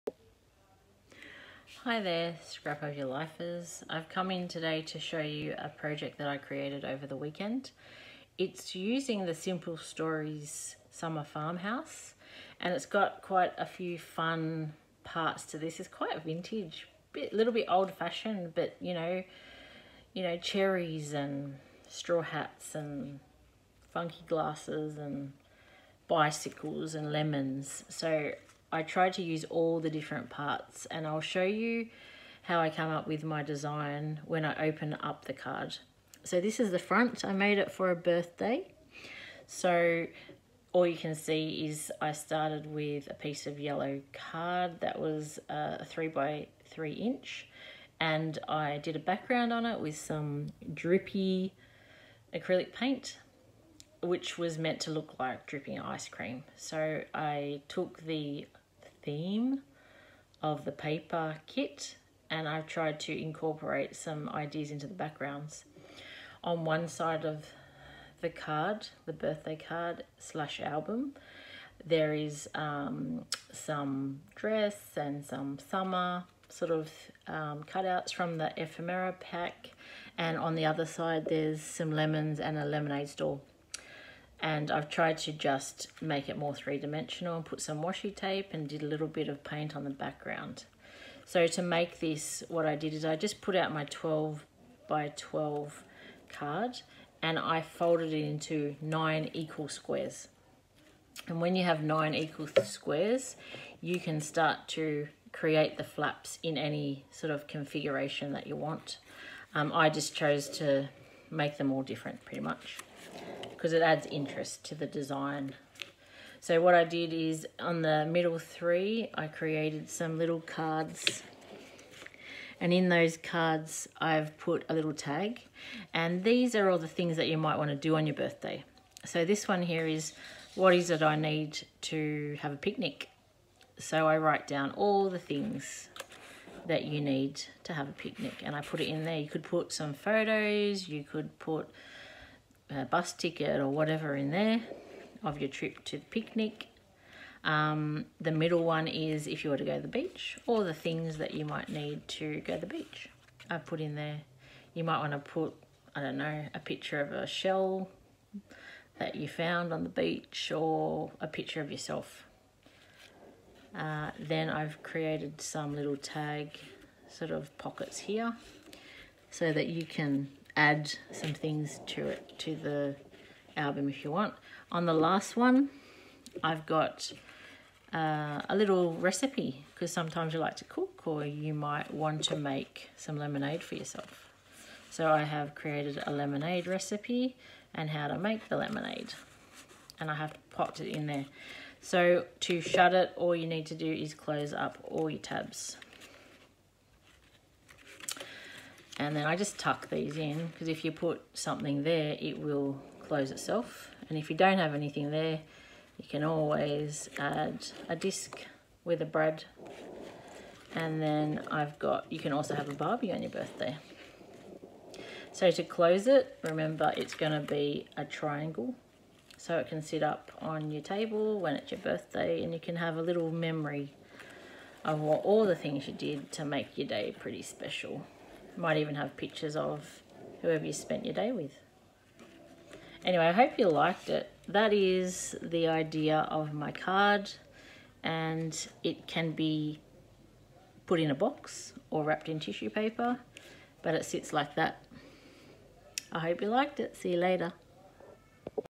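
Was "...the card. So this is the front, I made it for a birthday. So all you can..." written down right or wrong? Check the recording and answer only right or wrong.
right.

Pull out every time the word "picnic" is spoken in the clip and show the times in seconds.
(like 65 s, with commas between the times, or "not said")
132 s, 137 s, 146 s.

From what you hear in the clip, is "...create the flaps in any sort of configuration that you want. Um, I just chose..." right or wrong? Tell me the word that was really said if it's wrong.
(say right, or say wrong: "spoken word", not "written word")
right.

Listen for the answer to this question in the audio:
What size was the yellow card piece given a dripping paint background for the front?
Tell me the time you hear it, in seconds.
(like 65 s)
45 s.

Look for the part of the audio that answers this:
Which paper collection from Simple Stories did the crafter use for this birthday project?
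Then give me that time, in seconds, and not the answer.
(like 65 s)
10 s.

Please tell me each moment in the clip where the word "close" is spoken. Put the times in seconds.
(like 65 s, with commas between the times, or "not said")
194 s, 203 s, 215 s.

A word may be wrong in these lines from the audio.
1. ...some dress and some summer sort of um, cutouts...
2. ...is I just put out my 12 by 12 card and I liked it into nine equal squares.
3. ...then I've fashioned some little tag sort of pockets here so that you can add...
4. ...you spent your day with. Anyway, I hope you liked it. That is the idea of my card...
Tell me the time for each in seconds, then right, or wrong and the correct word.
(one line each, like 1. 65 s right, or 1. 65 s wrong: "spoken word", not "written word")
1. 73 s right
2. 92 s wrong: "folded", not "liked"
3. 164 s wrong: "created", not "fashioned"
4. 230 s right.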